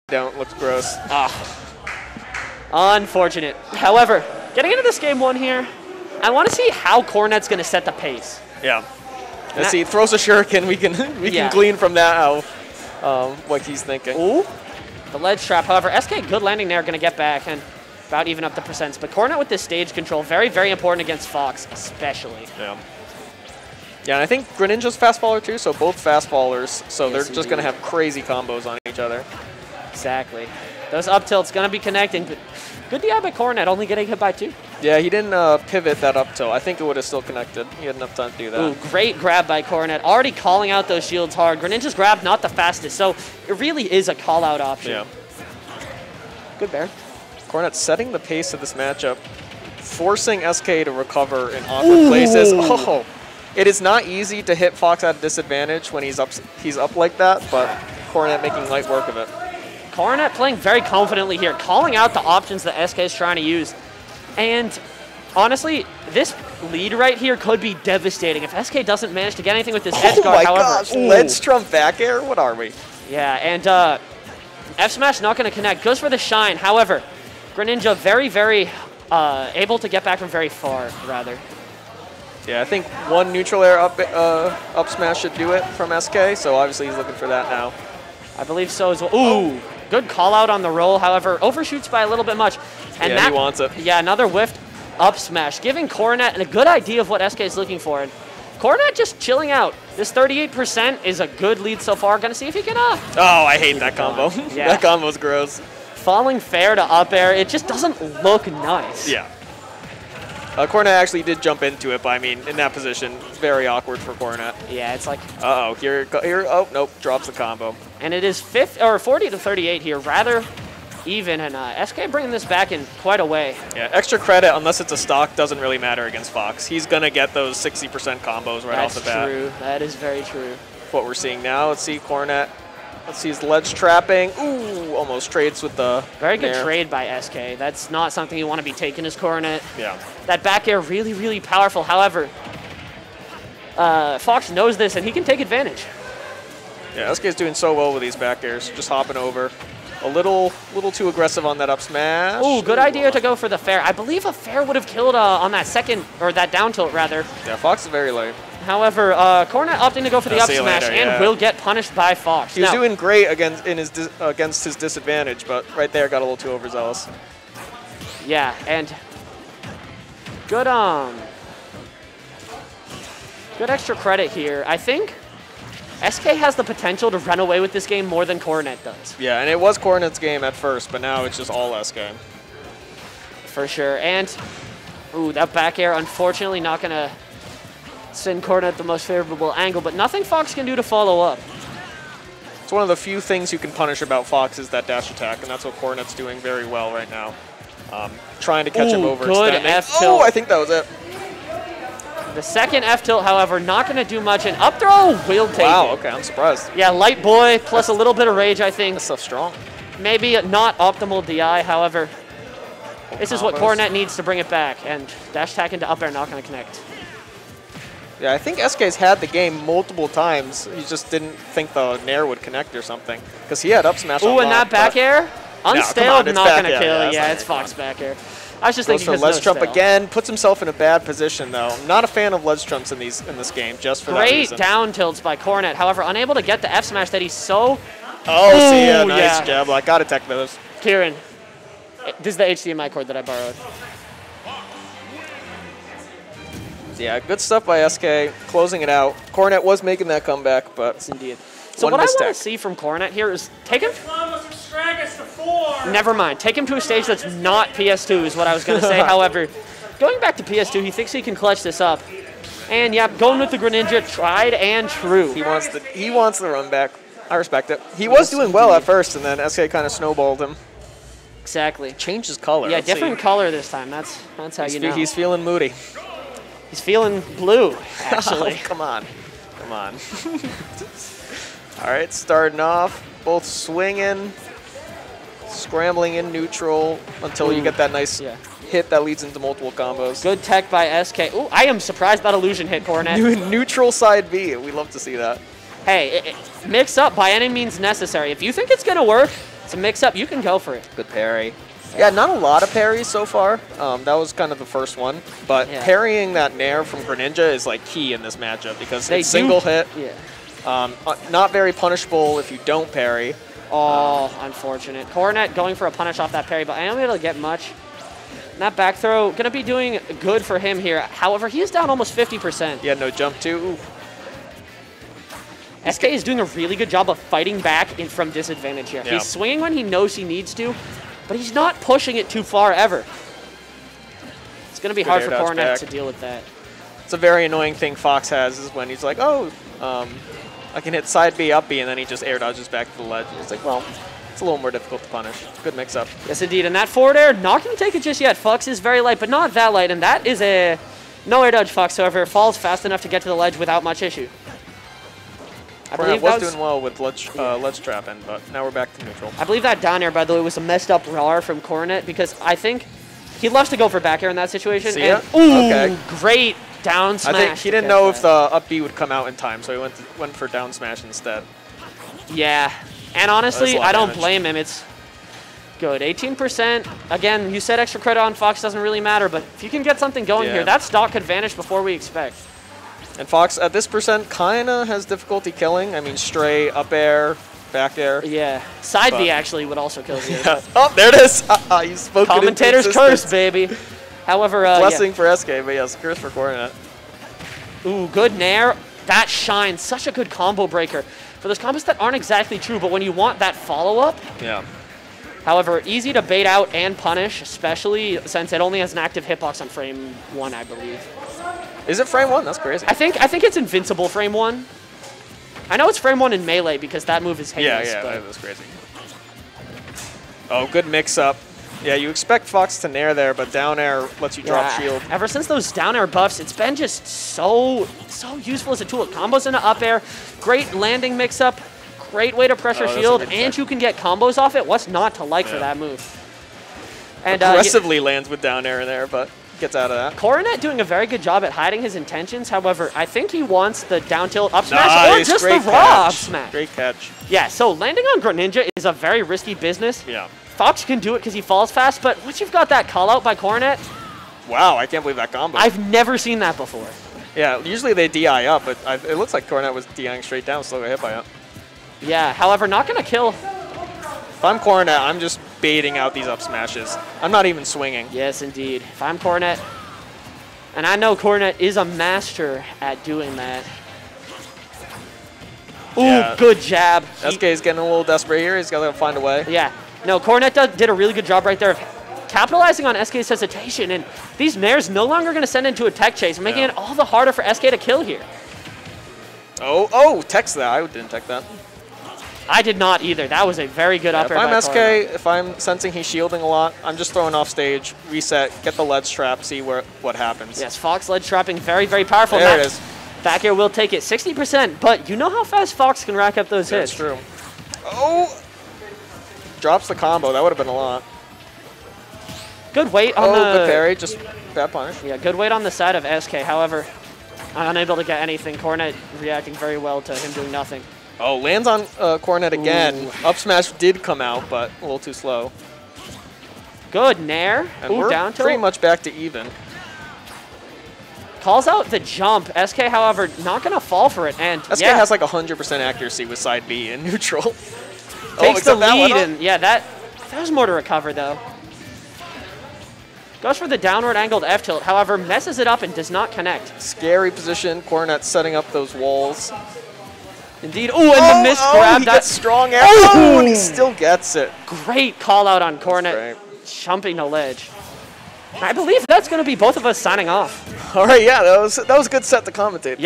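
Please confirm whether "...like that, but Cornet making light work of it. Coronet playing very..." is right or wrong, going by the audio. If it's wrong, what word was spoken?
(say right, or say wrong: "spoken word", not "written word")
right.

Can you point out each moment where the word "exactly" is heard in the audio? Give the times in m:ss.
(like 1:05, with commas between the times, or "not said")
0:29, 4:31, 6:42.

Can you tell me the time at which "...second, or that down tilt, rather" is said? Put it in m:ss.
2:35.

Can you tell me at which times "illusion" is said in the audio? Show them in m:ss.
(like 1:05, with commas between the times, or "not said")
4:52.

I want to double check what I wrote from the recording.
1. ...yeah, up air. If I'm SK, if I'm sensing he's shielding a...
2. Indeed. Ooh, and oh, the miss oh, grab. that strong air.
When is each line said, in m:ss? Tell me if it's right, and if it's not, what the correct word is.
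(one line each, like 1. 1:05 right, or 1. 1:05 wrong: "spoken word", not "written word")
1. 8:14 right
2. 9:10 right.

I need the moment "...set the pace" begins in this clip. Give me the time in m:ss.
0:07.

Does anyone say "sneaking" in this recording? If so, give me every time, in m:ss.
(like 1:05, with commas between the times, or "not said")
not said.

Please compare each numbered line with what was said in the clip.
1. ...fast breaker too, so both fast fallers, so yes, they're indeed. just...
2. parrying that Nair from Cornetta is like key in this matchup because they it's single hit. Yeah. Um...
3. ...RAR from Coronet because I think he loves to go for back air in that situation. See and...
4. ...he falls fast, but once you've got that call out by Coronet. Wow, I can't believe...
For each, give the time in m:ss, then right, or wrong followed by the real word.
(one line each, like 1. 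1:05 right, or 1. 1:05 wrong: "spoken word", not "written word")
1. 0:24 wrong: "faller", not "breaker"
2. 5:05 wrong: "Greninja", not "Cornetta"
3. 6:01 right
4. 7:31 right.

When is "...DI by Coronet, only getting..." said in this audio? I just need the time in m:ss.
0:33.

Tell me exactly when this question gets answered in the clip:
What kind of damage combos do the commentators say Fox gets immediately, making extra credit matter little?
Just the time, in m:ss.
2:07.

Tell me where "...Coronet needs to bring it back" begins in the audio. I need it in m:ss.
3:33.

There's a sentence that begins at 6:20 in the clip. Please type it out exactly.
here, that stock could vanish before we expect.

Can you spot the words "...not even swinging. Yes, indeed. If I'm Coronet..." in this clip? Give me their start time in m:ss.
7:47.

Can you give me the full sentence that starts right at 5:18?
that back throw, going to be doing good for him here.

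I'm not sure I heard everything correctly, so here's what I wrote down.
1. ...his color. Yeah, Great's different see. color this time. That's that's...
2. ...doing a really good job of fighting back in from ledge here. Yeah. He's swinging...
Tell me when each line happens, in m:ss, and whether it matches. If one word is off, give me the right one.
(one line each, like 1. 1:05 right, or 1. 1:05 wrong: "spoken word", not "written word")
1. 4:32 wrong: "Let", not "Great"
2. 5:26 wrong: "disadvantage", not "ledge".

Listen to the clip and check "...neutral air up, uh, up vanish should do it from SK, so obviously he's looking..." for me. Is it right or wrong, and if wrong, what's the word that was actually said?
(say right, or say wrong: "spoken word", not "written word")
wrong: "smash", not "vanish".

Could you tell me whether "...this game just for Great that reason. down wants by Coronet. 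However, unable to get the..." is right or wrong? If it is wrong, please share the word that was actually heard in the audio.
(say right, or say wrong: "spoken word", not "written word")
wrong: "tilts", not "wants".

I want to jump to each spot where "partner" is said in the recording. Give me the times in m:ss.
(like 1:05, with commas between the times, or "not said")
not said.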